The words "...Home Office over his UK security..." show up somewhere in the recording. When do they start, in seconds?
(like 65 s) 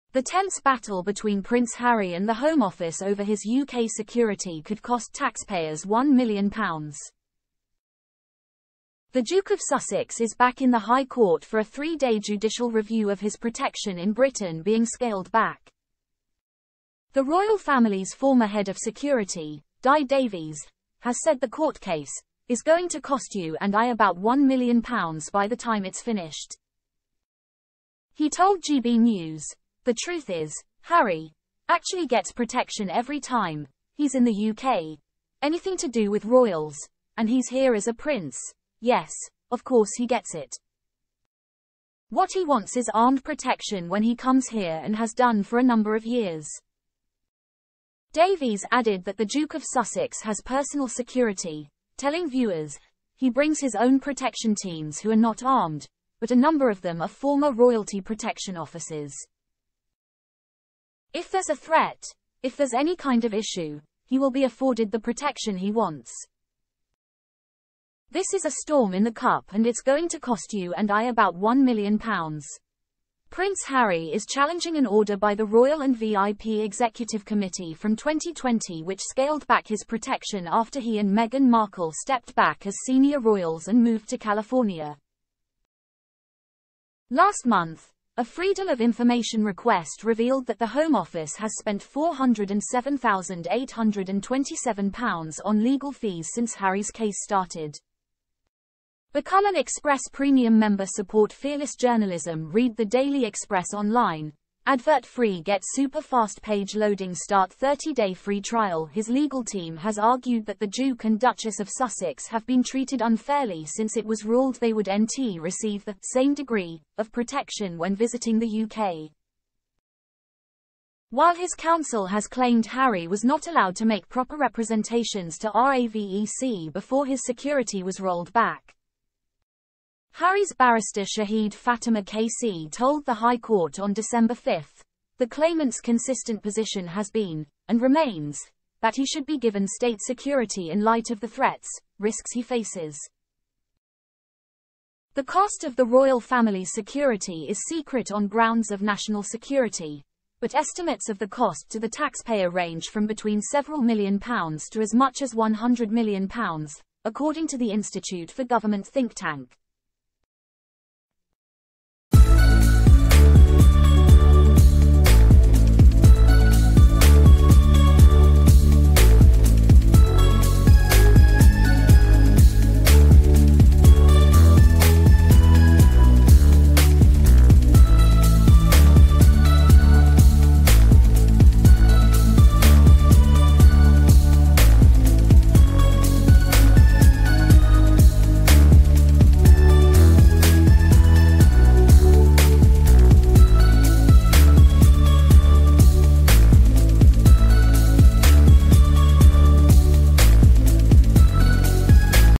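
2 s.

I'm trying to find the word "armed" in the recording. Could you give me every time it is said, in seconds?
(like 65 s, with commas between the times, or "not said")
42 s, 55 s.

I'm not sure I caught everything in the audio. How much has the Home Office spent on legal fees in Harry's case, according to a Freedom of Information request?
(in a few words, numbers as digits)
£407,827.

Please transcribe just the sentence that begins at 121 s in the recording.
While his counsel has claimed Harry was not allowed to make proper representations to RAVEC before his security was rolled back.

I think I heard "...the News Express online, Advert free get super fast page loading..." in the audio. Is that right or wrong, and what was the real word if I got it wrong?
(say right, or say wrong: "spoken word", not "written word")
wrong: "Daily", not "News".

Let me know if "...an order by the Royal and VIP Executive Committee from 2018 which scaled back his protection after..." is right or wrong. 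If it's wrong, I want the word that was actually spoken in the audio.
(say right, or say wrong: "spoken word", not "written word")
wrong: "2020", not "2018".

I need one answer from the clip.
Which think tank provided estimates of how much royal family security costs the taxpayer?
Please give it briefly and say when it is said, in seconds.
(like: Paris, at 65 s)
Institute for Government, at 157 s.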